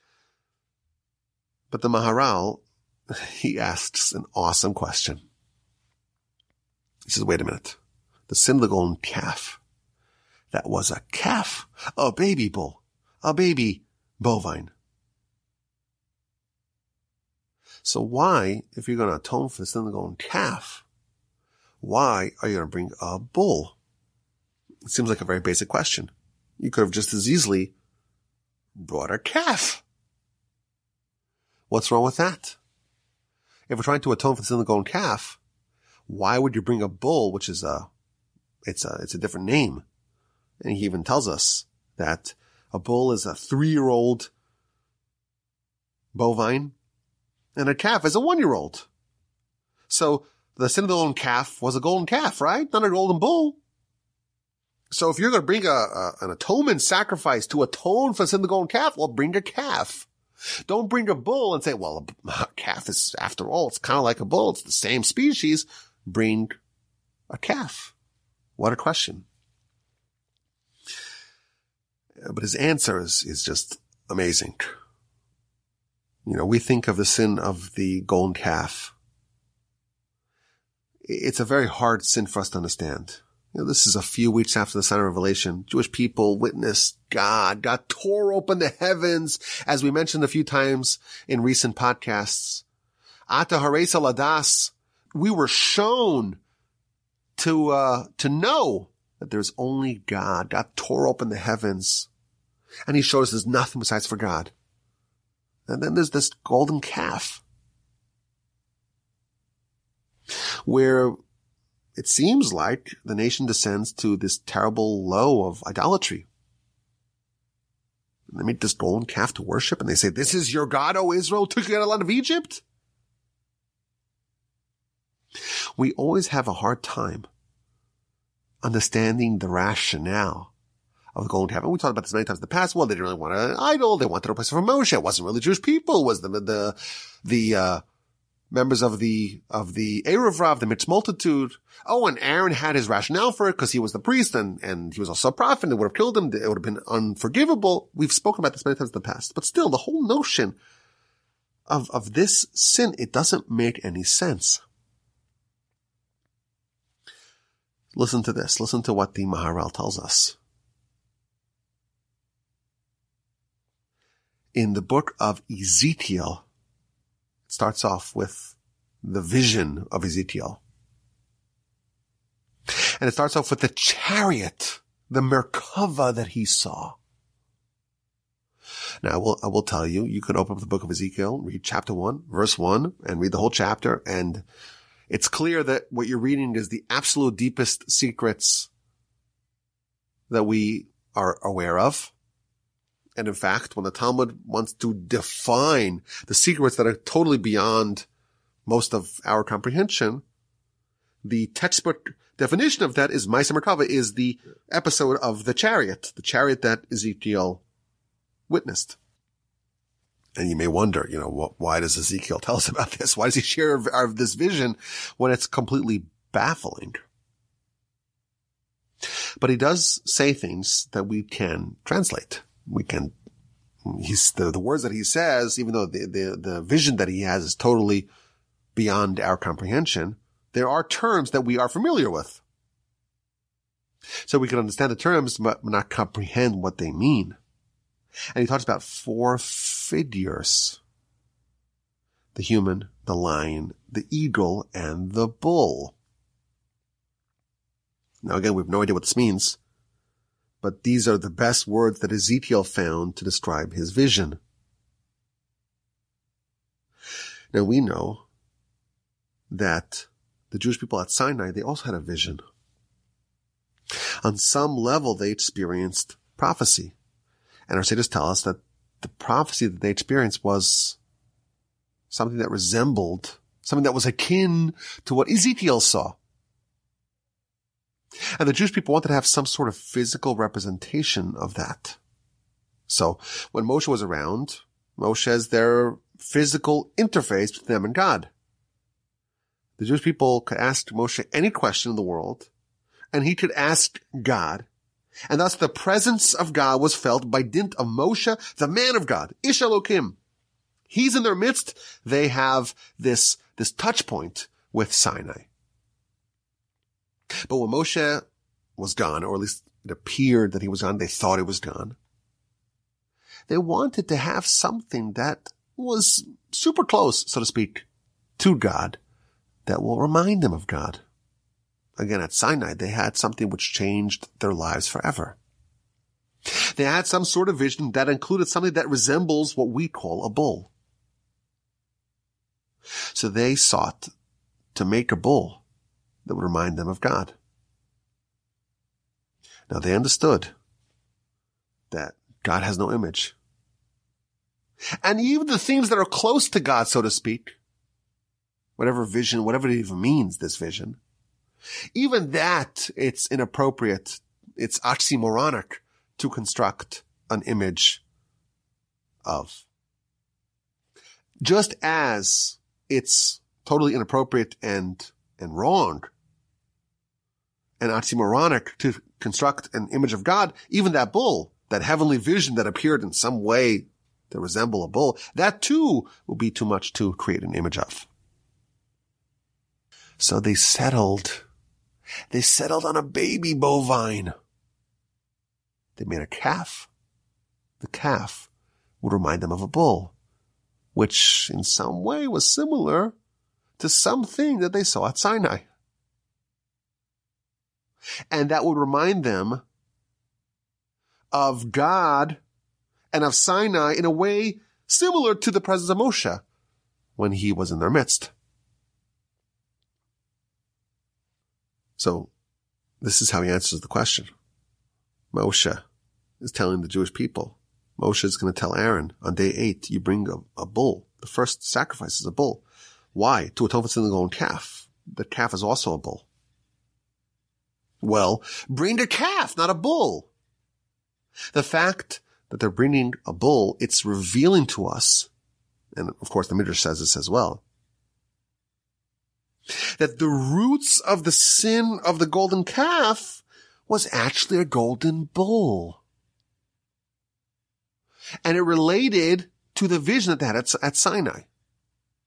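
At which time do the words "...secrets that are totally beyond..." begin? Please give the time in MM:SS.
03:16.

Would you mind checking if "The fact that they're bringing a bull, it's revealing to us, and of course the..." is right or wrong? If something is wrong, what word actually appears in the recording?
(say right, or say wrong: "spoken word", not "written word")
right.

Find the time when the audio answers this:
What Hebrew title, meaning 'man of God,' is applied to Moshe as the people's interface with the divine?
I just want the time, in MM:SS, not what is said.
04:59.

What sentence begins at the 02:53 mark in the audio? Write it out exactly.
And it starts off with the chariot, the Merkava that he saw.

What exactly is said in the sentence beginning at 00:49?
So the golden calf was a golden calf, right?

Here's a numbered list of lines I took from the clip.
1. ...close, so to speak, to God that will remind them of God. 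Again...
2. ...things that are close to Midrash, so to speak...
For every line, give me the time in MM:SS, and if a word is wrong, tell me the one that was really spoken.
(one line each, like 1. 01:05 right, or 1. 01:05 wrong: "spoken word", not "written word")
1. 05:16 right
2. 05:45 wrong: "God", not "Midrash".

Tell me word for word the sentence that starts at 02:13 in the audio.
They wanted a place for Moshe.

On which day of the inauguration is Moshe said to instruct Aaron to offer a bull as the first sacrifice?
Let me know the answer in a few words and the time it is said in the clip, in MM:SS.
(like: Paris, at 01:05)
Day 8, at 06:59.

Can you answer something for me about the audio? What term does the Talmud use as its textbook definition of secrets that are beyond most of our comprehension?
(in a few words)
Maisa Merkava.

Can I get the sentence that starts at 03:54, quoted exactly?
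So we can understand the terms, but not comprehend what they mean.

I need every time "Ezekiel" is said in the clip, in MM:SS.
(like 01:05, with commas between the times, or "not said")
02:45, 02:50, 03:00, 03:26, 03:31, 04:12, 04:35.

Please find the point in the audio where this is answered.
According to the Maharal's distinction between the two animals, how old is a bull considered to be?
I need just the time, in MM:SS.
00:43.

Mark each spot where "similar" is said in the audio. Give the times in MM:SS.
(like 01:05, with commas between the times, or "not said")
06:32, 06:44.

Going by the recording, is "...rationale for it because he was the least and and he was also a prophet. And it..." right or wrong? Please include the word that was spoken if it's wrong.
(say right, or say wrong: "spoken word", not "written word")
wrong: "priest", not "least".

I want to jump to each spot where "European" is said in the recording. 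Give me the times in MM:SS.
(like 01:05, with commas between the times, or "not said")
not said.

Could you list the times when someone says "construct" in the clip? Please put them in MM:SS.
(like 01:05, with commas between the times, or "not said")
05:56, 06:09.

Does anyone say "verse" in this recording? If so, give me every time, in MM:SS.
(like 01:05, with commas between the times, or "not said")
03:02.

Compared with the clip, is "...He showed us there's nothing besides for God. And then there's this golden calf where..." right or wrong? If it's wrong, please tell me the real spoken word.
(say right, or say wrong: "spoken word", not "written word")
right.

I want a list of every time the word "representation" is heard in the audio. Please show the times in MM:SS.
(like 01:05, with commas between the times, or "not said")
04:40.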